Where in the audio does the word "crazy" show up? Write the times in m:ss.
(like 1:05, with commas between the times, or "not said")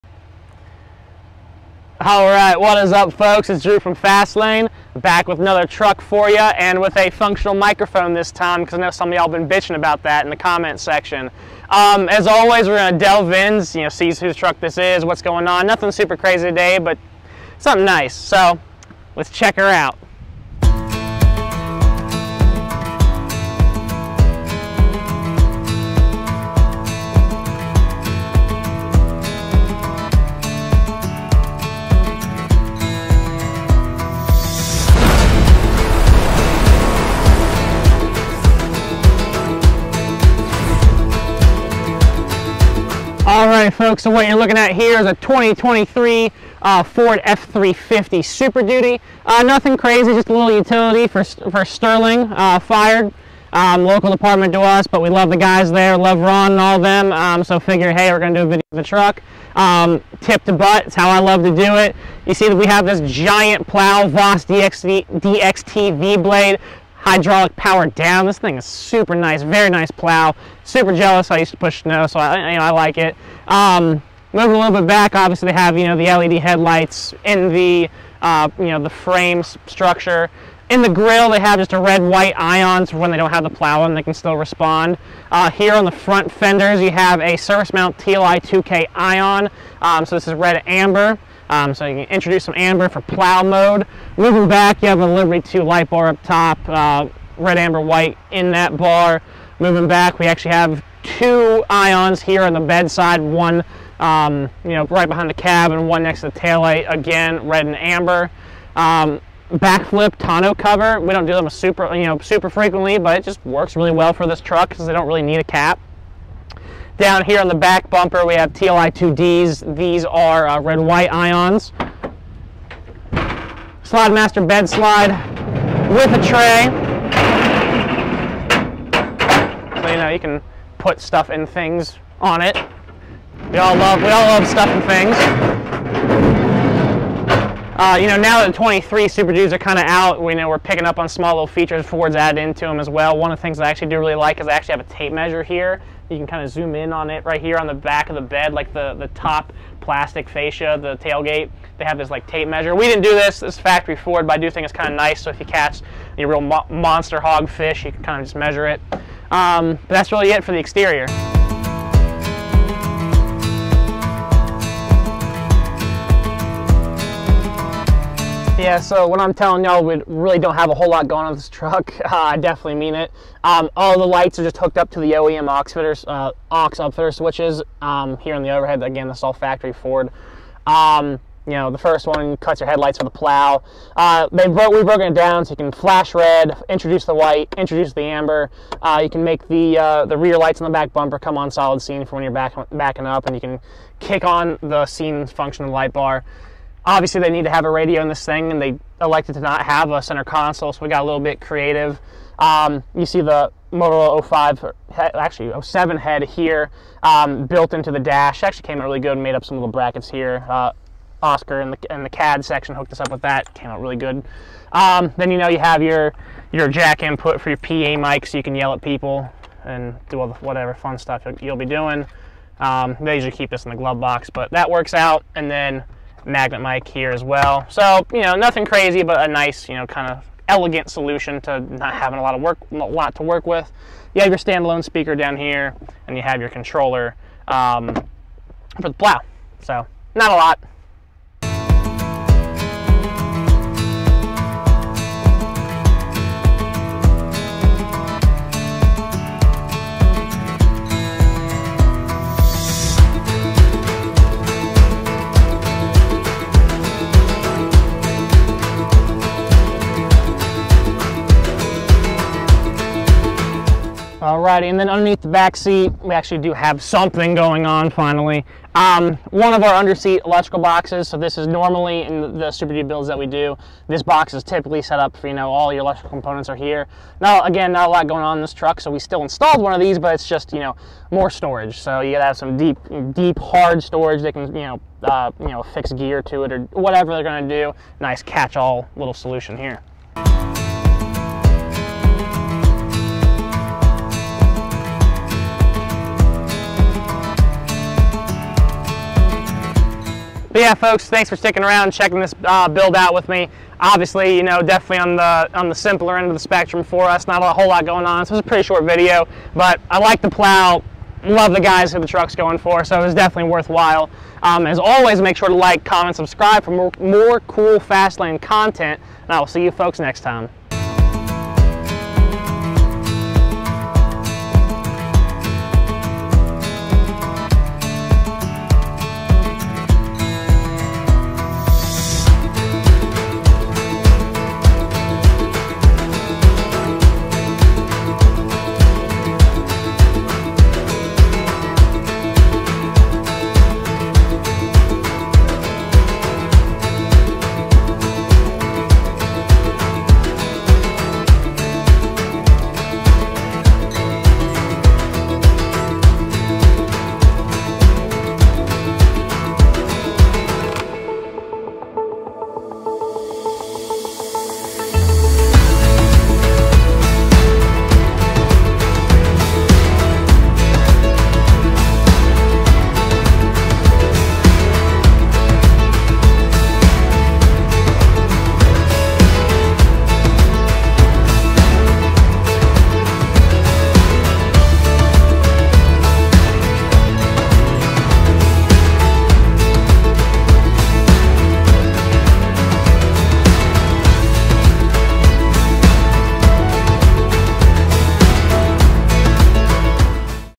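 0:16, 0:49, 3:48.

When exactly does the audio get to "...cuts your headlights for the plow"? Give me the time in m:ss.
3:02.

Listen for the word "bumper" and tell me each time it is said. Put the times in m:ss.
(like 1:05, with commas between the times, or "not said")
1:57, 3:10.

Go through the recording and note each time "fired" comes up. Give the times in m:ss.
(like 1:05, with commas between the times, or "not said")
0:52.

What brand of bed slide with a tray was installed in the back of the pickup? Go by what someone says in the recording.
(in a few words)
SlideMaster.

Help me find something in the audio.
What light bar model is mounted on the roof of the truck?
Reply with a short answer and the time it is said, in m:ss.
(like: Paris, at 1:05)
Liberty 2, at 1:35.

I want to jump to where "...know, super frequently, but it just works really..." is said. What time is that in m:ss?
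1:52.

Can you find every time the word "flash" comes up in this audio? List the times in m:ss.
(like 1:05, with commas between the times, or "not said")
3:05.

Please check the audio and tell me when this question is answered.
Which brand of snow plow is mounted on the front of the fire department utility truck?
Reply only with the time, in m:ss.
1:04.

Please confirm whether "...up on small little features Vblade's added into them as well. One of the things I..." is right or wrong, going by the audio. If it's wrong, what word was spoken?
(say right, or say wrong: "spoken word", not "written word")
wrong: "Ford", not "Vblade".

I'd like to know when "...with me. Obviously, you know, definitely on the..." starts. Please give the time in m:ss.
5:03.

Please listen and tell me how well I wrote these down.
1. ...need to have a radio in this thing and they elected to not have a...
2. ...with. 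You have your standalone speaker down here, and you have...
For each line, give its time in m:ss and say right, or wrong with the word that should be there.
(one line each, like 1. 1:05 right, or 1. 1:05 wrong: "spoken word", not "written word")
1. 3:17 right
2. 3:53 right.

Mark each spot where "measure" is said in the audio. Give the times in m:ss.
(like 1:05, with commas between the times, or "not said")
2:25, 2:32, 2:38.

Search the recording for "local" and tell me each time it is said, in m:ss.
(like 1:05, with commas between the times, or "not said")
0:53.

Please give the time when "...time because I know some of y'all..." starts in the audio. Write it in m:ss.
0:08.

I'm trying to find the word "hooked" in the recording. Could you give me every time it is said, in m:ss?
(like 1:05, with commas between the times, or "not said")
2:54, 3:32.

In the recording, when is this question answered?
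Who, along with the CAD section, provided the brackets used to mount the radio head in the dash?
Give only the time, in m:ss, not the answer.
3:31.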